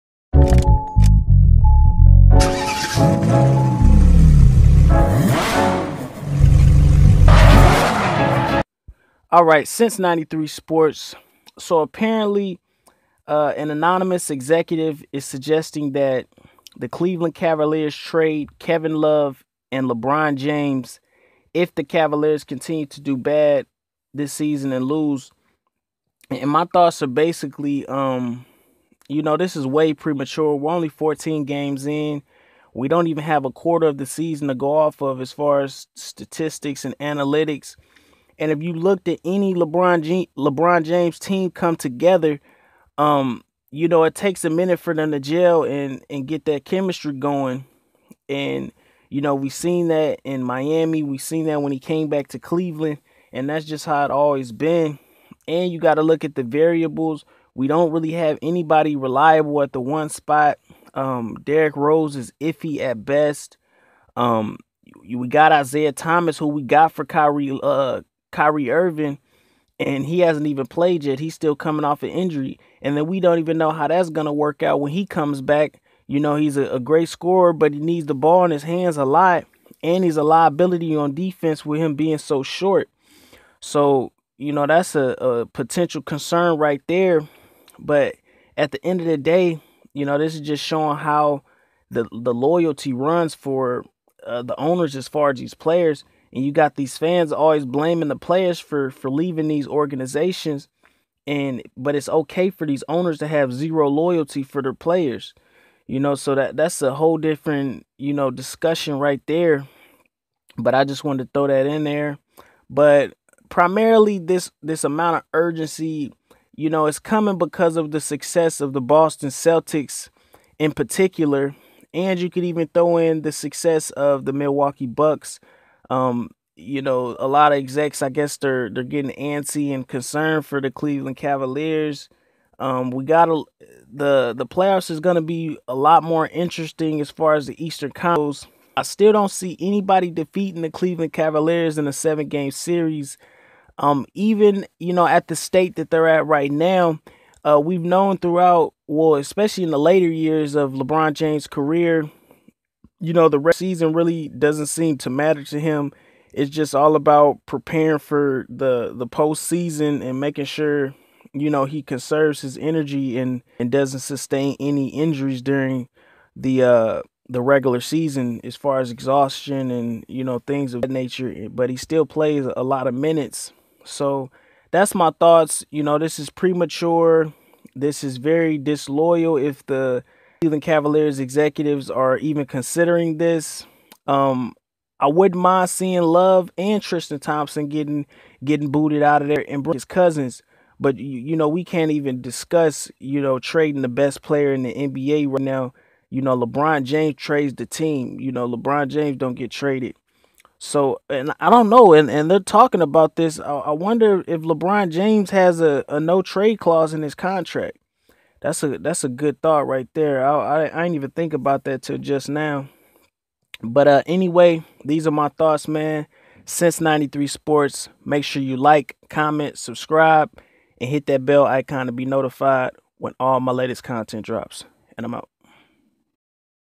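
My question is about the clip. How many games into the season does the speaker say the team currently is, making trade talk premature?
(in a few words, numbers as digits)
14.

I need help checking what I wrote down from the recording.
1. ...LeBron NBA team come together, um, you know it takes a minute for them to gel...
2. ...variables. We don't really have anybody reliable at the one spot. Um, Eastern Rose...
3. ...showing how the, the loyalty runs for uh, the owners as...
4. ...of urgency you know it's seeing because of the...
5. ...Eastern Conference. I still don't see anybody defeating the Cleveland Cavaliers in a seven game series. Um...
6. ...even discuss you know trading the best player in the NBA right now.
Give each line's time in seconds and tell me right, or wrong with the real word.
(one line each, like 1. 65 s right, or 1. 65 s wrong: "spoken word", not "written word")
1. 40 s wrong: "James", not "NBA"
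2. 56 s wrong: "Derrick", not "Eastern"
3. 90 s right
4. 115 s wrong: "coming", not "seeing"
5. 137 s right
6. 191 s right.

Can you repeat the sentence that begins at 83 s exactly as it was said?
So, you know, that's a, a potential concern right there.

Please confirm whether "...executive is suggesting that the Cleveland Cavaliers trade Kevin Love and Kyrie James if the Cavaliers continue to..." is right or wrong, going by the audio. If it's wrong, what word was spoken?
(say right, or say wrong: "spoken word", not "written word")
wrong: "LeBron", not "Kyrie".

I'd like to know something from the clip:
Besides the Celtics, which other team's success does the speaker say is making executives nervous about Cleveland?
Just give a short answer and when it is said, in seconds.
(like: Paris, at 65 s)
Milwaukee Bucks, at 124 s.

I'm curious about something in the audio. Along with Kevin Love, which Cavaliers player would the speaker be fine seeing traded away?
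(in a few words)
Tristan Thompson.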